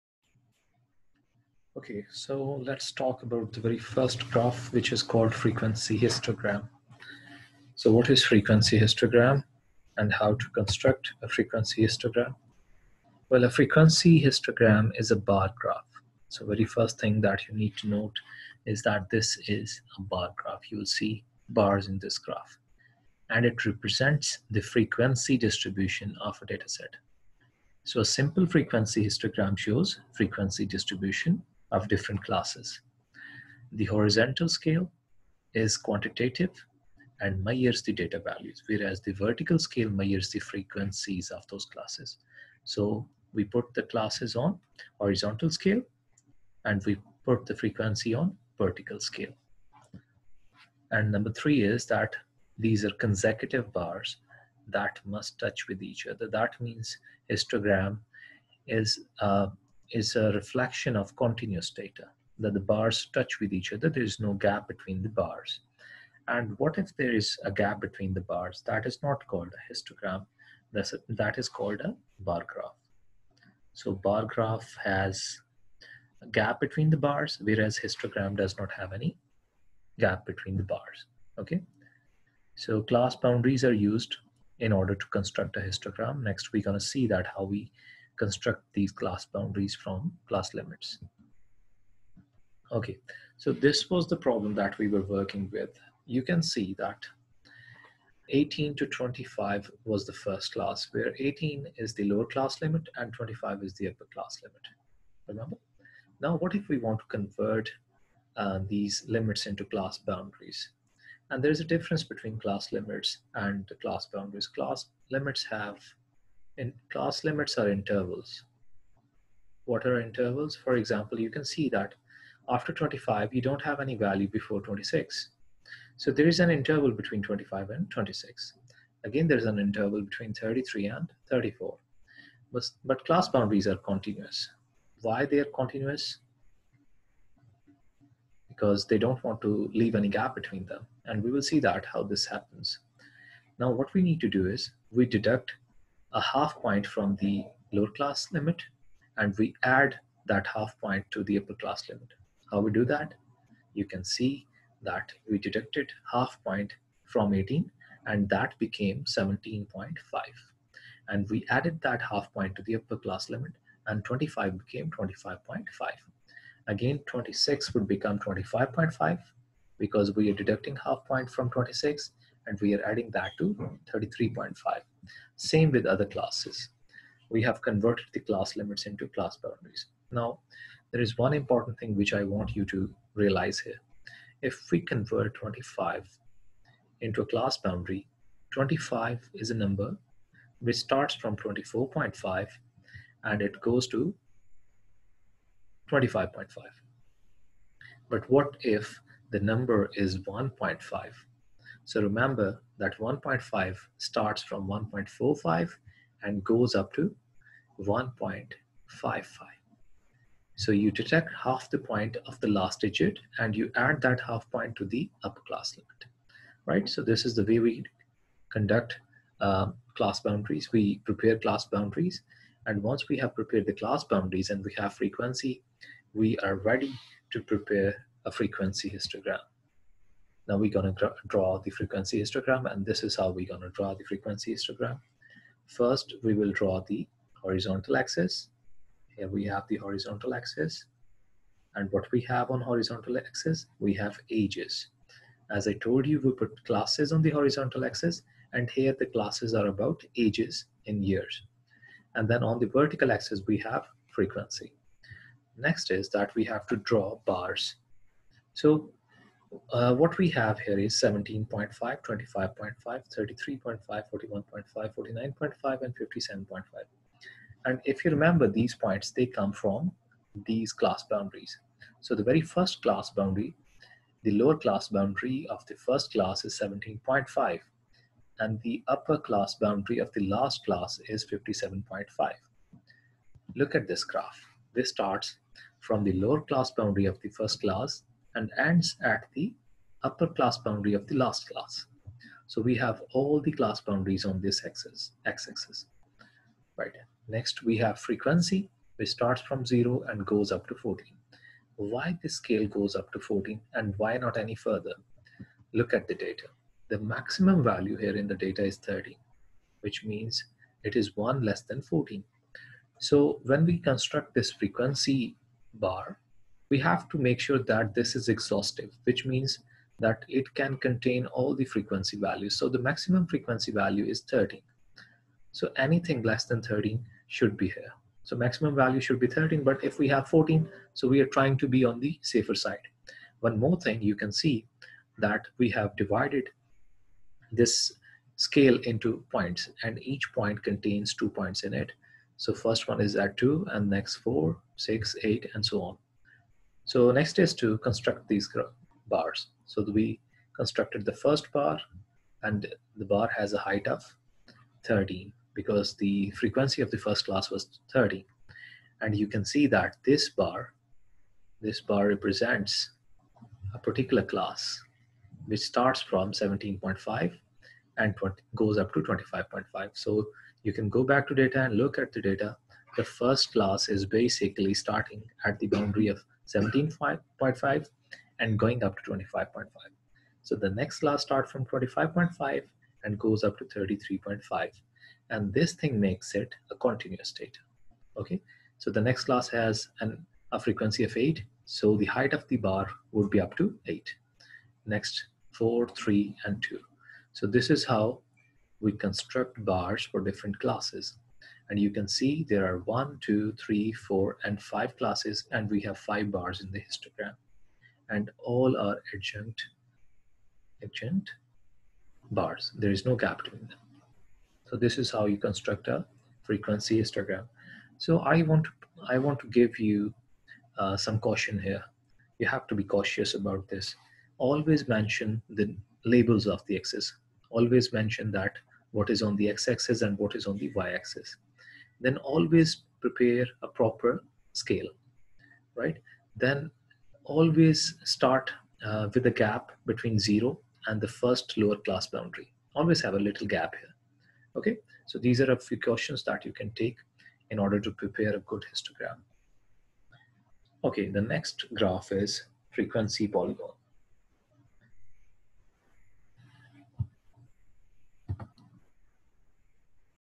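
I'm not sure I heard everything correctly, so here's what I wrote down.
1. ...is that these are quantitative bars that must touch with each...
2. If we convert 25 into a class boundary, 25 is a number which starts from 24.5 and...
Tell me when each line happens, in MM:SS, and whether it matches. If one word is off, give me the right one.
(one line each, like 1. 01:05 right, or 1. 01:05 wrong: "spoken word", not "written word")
1. 00:51 wrong: "consecutive", not "quantitative"
2. 03:04 right.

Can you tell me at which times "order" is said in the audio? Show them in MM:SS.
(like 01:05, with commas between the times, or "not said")
01:24, 07:27.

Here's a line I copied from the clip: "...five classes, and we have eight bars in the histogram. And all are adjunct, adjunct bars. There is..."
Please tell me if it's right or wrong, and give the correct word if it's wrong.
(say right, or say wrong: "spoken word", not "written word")
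wrong: "five", not "eight".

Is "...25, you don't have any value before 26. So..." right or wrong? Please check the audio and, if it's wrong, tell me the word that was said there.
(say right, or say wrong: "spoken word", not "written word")
right.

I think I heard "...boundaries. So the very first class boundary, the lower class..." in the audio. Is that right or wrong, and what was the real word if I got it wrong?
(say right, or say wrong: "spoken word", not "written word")
right.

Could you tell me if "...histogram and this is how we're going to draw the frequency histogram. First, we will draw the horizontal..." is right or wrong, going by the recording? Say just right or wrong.
right.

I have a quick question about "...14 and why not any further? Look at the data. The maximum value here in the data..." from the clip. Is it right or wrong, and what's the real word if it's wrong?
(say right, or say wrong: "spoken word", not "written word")
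right.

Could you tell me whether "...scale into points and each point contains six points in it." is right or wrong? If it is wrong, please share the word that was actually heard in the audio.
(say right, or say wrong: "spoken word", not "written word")
wrong: "two", not "six".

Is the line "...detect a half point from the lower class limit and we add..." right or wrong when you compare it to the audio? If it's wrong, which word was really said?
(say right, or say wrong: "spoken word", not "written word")
wrong: "deduct", not "detect".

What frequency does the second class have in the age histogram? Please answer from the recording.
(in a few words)
8.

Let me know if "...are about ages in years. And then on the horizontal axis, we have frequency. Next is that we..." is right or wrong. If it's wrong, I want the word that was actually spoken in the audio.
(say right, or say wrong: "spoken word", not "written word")
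wrong: "vertical", not "horizontal".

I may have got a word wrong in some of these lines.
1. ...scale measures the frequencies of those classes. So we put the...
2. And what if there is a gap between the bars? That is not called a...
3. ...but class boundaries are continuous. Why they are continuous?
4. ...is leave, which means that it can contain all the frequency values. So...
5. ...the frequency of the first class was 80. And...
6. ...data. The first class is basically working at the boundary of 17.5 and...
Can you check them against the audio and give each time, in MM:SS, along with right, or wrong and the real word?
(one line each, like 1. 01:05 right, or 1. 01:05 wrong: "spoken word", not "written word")
1. 00:39 right
2. 01:06 right
3. 02:12 right
4. 05:18 wrong: "exhaustive", not "leave"
5. 05:55 wrong: "30", not "80"
6. 06:12 wrong: "starting", not "working".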